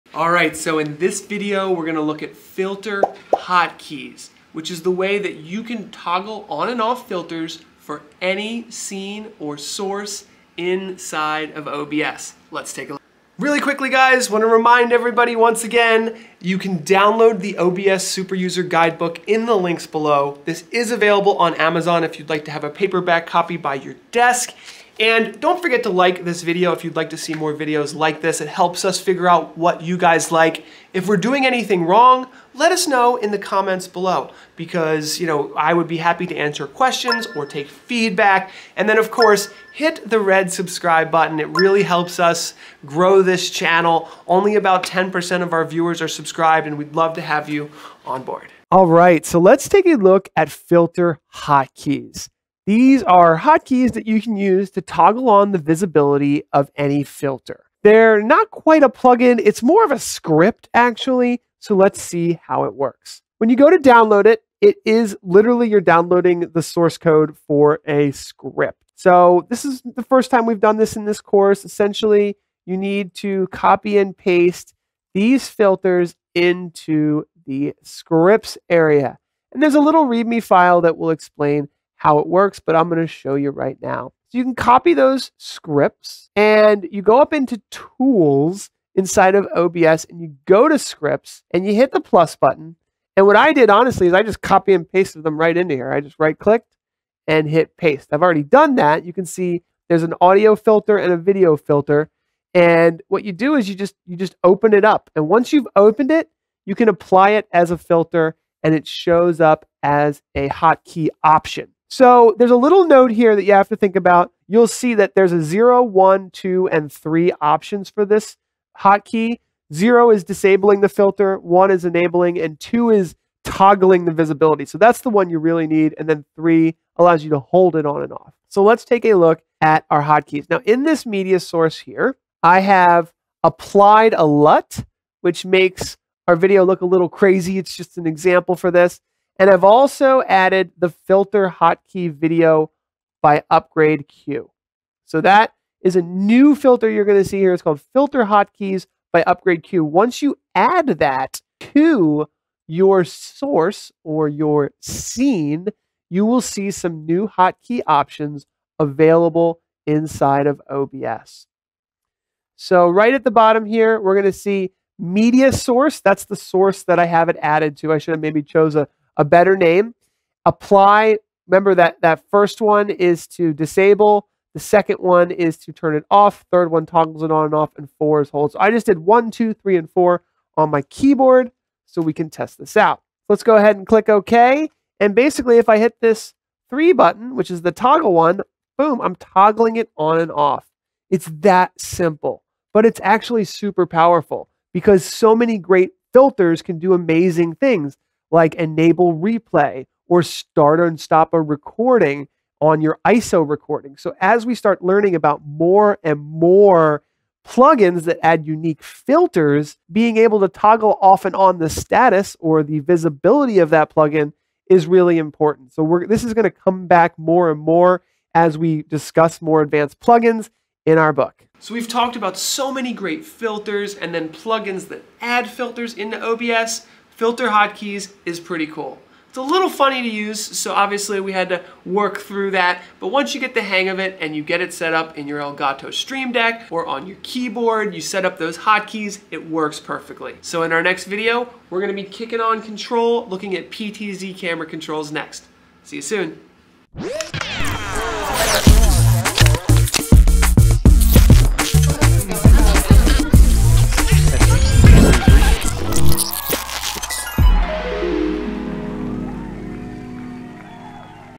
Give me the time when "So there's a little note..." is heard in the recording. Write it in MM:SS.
01:51.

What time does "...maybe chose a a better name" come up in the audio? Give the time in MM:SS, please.
02:48.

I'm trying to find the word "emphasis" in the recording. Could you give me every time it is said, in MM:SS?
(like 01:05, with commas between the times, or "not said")
not said.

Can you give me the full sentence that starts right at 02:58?
So I just did one, two, three, and four on my keyboard so we can test this out.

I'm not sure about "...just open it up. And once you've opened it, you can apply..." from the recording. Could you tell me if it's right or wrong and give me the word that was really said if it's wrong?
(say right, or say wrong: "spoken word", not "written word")
right.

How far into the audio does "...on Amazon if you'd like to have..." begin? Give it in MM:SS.
00:21.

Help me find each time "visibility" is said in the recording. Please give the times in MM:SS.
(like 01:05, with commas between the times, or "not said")
00:55, 02:04, 03:32.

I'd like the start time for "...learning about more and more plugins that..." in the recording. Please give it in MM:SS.
03:24.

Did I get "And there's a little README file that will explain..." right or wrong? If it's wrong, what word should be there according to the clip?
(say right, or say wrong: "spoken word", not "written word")
right.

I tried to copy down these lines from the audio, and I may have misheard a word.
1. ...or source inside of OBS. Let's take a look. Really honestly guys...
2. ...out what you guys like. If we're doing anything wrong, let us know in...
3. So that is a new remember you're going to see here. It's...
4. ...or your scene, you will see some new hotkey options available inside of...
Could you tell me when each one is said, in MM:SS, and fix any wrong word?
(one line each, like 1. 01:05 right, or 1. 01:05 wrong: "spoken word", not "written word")
1. 00:09 wrong: "quickly", not "honestly"
2. 00:29 right
3. 02:25 wrong: "filter", not "remember"
4. 02:34 right.